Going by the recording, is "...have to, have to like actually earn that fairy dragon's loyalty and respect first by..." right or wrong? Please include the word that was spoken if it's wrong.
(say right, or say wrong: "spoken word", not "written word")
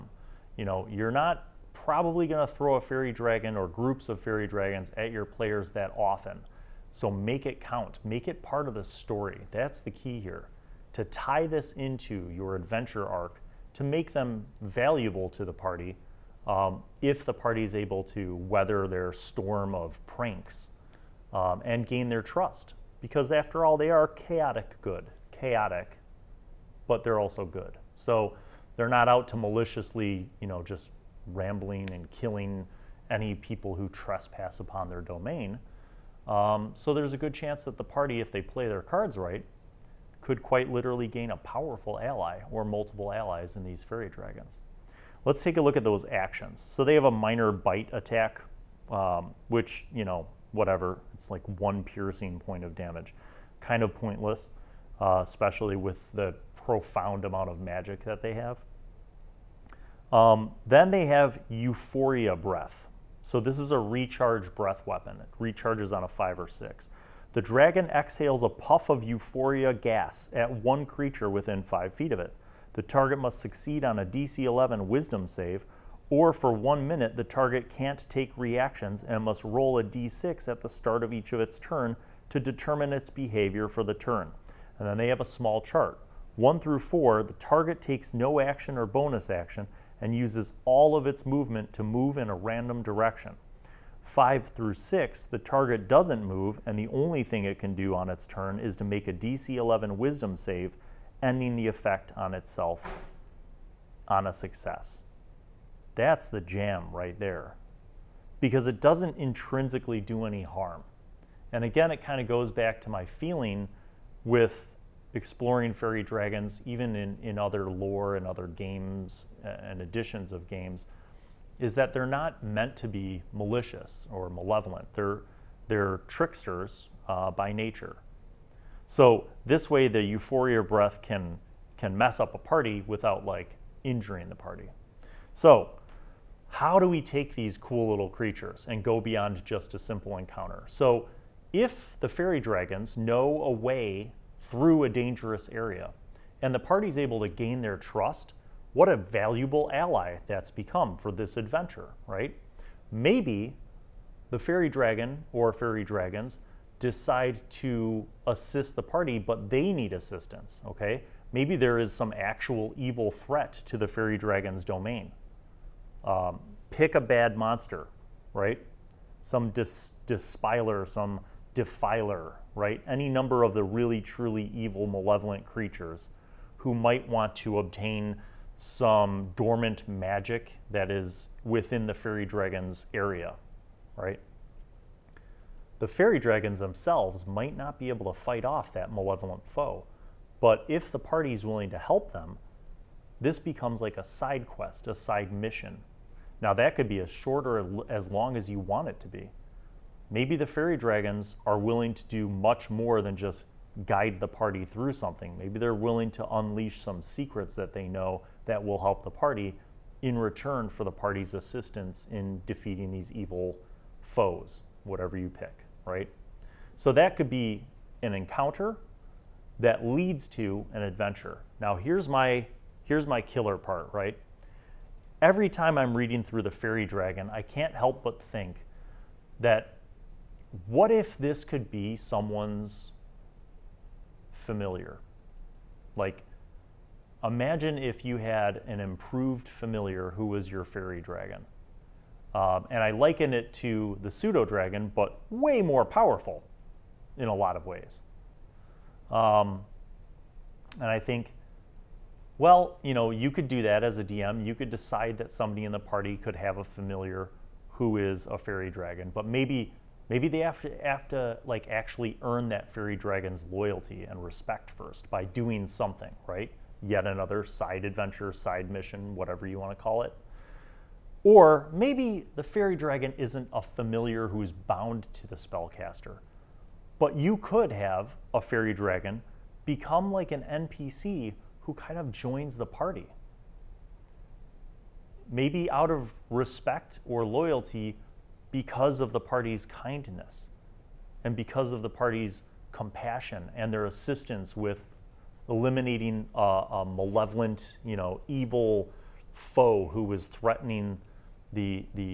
right.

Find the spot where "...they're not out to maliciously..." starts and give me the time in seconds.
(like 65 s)
28 s.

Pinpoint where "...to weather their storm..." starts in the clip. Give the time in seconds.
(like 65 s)
18 s.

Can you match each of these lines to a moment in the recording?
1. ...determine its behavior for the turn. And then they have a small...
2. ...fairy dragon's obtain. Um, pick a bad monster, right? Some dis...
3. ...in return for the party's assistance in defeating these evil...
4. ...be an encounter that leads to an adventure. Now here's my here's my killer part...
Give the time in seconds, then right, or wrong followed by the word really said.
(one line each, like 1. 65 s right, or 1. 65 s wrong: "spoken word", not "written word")
1. 82 s right
2. 163 s wrong: "domain", not "obtain"
3. 210 s right
4. 217 s right.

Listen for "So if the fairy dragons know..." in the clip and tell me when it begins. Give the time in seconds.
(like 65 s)
140 s.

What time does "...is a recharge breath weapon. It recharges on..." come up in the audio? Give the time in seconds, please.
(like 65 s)
63 s.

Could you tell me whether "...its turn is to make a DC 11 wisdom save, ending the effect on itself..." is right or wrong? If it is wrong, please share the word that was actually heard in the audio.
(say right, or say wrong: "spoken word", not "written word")
right.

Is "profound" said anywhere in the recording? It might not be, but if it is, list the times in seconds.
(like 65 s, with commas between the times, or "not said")
56 s.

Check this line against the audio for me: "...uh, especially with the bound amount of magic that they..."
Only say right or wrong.
wrong.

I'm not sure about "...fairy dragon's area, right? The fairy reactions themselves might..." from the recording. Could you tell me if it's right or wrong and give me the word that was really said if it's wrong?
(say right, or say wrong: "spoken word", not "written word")
wrong: "dragons", not "reactions".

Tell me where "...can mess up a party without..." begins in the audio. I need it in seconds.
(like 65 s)
131 s.